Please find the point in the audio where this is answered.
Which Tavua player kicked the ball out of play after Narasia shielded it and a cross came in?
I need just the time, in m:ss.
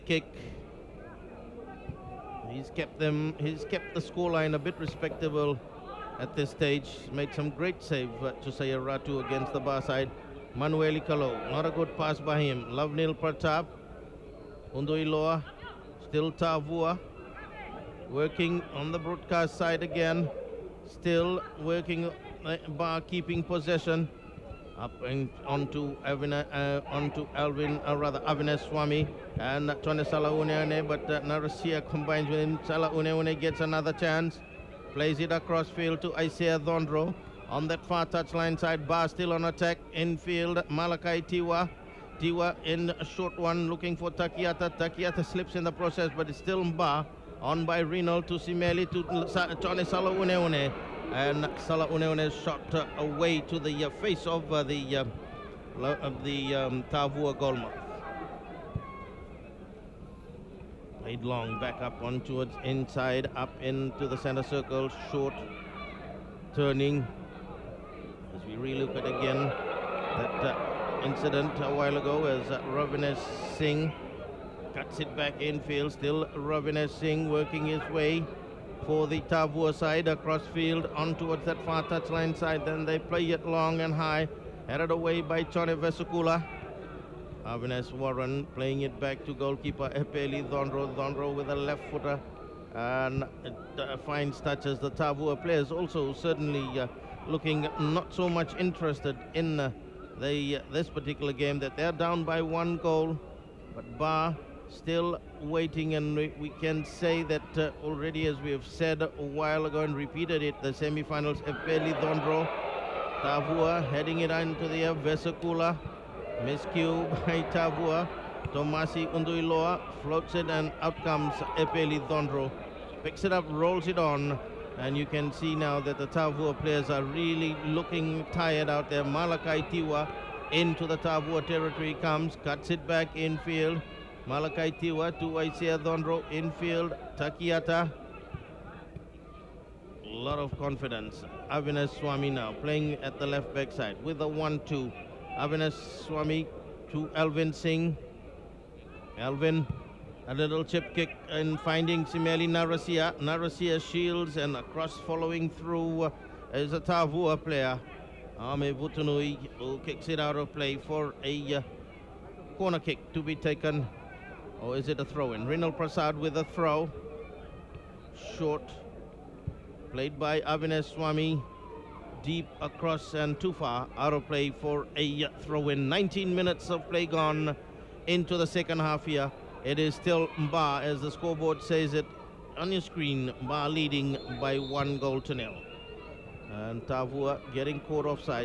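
2:38.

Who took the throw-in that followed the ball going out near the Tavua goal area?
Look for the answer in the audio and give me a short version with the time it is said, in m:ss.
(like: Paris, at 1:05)
Rinal Prasad, at 2:45.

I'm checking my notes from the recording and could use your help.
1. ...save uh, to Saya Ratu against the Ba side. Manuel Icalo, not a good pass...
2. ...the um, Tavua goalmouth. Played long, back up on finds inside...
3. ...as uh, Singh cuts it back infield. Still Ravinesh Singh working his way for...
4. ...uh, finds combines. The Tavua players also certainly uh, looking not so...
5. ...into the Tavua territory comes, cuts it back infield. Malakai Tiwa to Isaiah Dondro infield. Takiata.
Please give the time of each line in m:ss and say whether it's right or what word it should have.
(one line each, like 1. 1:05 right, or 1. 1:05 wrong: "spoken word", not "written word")
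1. 0:07 right
2. 0:56 wrong: "towards", not "finds"
3. 1:12 right
4. 1:33 wrong: "touches", not "combines"
5. 2:10 right.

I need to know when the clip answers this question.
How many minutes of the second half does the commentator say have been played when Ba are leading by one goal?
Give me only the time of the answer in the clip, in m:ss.
2:55.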